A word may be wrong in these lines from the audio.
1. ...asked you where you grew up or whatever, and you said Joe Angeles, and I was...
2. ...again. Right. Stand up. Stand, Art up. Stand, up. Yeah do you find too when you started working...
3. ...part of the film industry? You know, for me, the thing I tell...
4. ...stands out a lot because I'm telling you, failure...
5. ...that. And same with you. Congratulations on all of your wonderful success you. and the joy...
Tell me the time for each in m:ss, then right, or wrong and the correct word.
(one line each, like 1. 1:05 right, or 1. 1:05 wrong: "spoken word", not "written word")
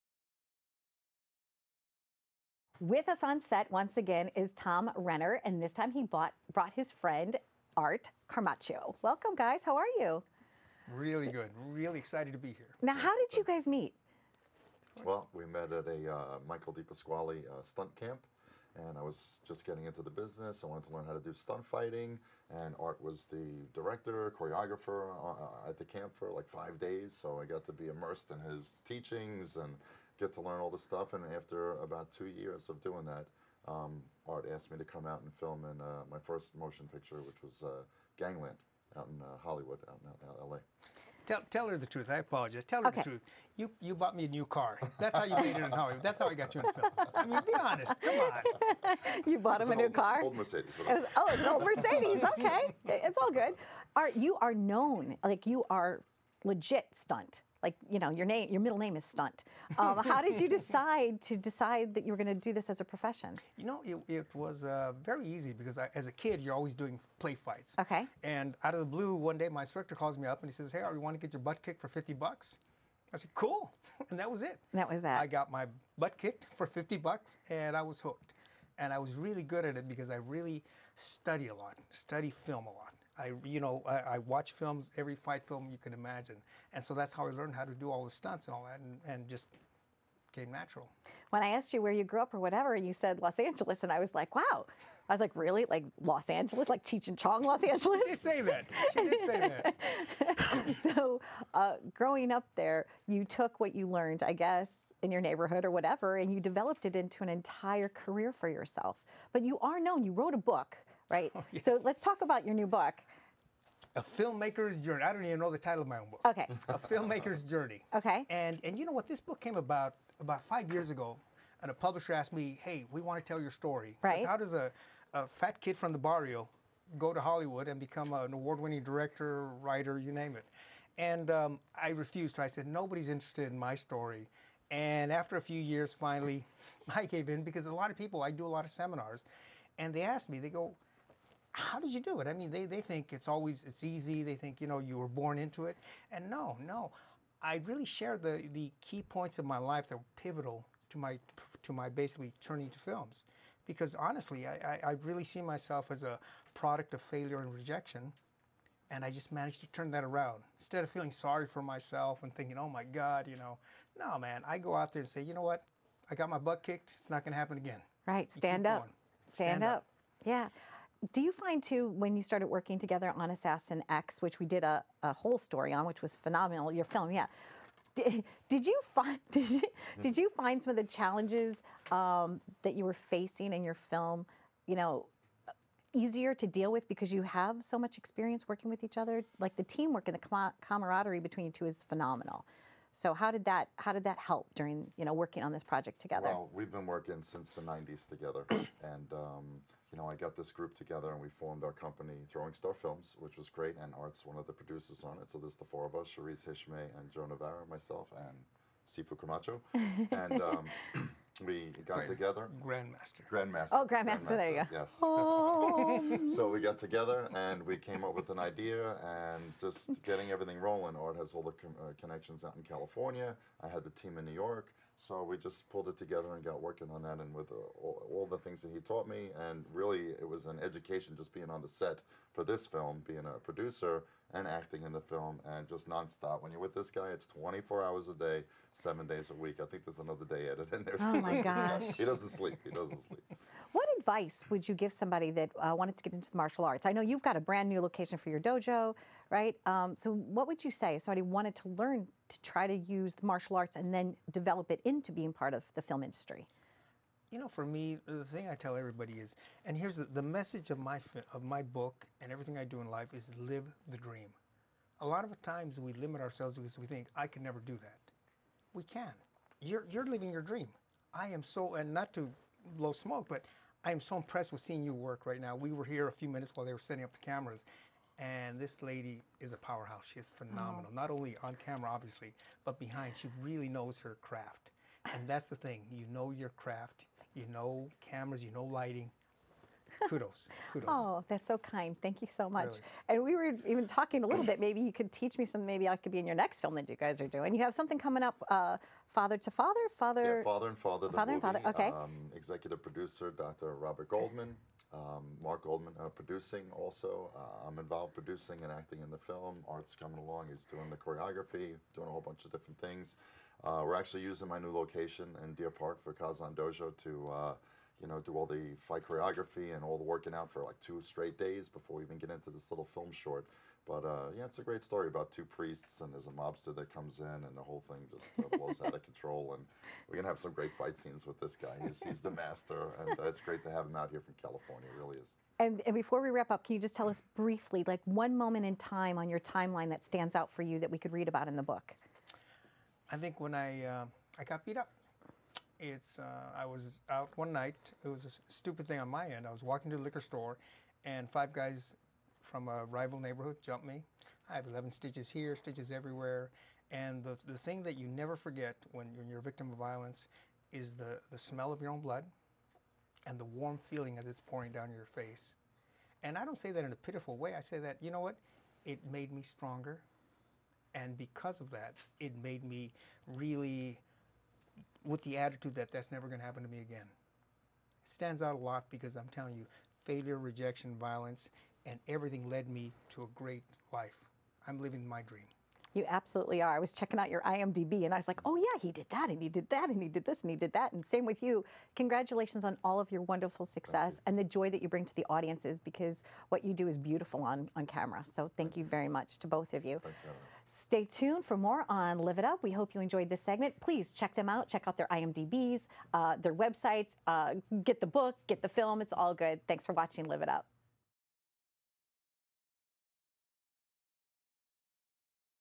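1. 1:31 wrong: "Los", not "Joe"
2. 2:47 wrong: "Stand", not "Art"
3. 4:15 right
4. 6:18 right
5. 6:30 right.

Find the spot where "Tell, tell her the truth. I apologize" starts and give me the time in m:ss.
0:41.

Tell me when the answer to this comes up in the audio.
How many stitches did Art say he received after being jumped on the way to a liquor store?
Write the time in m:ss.
5:54.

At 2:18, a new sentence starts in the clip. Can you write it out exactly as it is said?
I do a lot of seminars, and they asked me.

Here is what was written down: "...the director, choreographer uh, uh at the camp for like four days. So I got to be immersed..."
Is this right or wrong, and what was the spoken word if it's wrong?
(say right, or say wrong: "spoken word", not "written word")
wrong: "five", not "four".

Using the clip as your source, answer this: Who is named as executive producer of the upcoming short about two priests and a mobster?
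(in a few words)
Dr. Robert Goldman.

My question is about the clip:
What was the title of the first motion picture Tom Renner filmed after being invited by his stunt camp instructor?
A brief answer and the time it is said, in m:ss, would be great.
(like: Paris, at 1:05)
Gangland, at 0:38.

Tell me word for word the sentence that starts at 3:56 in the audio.
When you're with this guy, it's 24 hours a day, seven days a week.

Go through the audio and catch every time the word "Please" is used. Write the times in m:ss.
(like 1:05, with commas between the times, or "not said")
6:43.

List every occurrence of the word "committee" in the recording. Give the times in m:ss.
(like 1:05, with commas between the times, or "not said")
not said.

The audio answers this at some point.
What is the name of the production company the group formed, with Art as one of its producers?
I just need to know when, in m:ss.
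3:22.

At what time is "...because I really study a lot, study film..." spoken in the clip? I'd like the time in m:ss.
1:19.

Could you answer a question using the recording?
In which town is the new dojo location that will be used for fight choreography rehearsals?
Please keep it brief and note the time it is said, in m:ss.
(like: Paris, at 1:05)
Deer Park, at 5:15.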